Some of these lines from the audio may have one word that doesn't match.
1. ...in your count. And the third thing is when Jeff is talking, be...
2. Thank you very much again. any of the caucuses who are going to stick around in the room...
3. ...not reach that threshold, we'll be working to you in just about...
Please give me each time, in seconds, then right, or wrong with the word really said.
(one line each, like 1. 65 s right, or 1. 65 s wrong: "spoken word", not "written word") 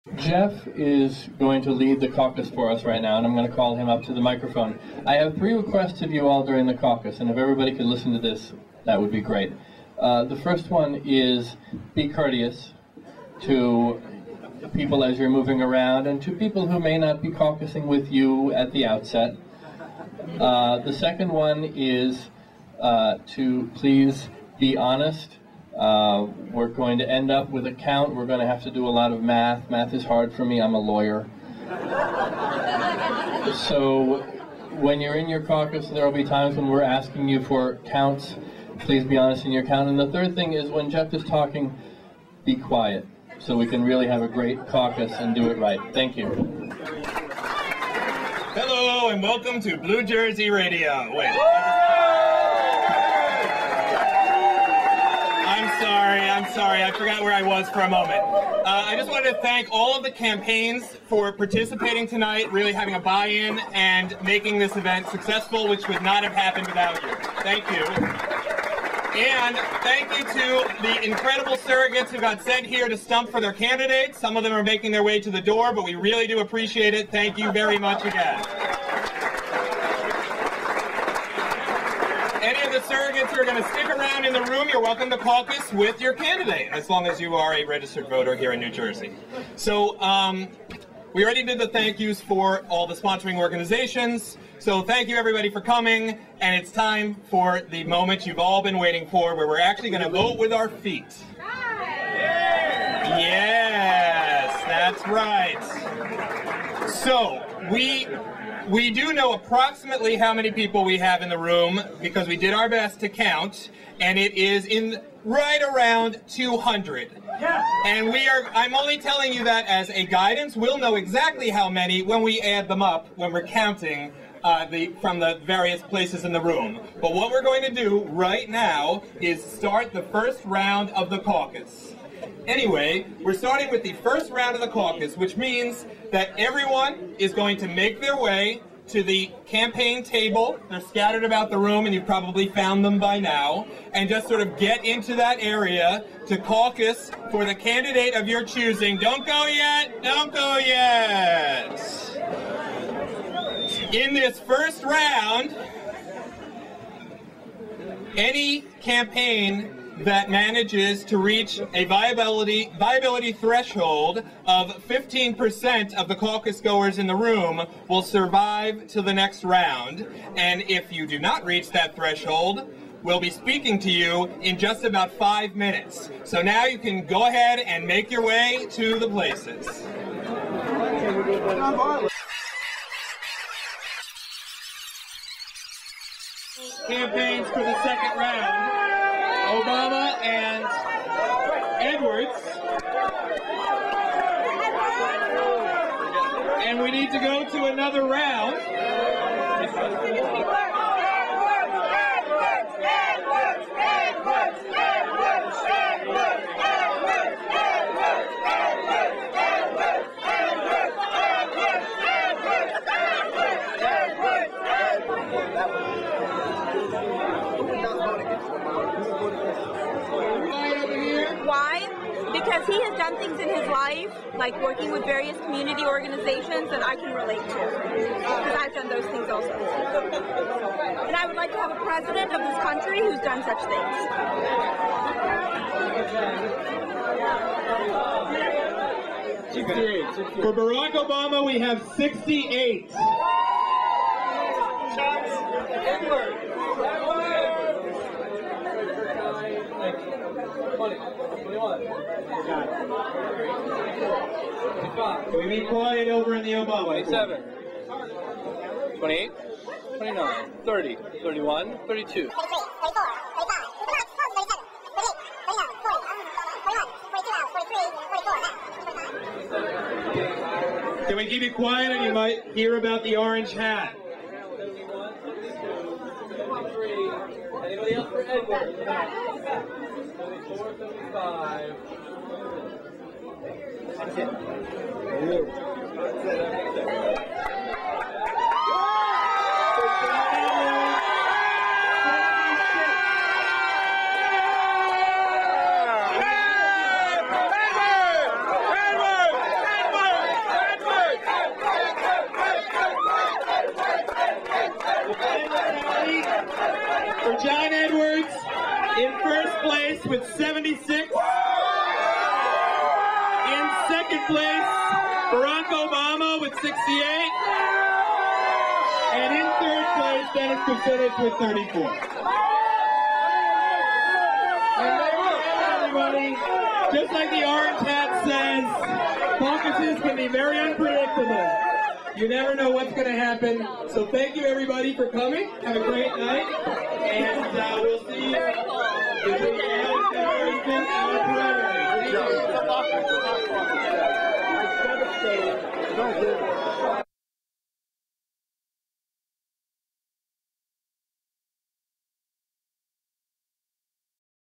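1. 39 s right
2. 77 s wrong: "surrogates", not "caucuses"
3. 171 s wrong: "speaking", not "working".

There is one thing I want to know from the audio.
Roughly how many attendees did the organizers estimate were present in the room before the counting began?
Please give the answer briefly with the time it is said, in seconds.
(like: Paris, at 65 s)
200, at 116 s.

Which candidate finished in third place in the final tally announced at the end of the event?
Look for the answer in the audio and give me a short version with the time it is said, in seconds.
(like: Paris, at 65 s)
Dennis Kucinich, at 320 s.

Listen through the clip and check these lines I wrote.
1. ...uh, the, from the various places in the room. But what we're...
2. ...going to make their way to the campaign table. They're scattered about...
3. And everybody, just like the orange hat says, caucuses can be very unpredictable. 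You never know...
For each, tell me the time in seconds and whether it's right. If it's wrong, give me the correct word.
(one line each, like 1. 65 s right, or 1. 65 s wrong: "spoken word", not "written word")
1. 124 s right
2. 137 s right
3. 324 s right.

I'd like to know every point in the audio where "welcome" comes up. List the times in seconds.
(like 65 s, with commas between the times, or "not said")
49 s, 84 s.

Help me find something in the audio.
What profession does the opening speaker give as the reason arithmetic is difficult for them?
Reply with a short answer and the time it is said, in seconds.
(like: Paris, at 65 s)
Lawyer, at 30 s.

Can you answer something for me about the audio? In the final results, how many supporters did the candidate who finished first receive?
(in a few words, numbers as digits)
76.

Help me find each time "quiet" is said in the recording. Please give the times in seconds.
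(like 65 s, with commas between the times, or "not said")
42 s, 255 s, 271 s.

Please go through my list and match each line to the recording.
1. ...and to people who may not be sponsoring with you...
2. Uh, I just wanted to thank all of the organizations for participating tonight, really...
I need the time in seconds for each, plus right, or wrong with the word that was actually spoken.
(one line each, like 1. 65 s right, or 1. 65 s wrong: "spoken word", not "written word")
1. 16 s wrong: "caucusing", not "sponsoring"
2. 58 s wrong: "campaigns", not "organizations".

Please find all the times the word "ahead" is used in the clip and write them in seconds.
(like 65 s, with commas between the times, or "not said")
177 s.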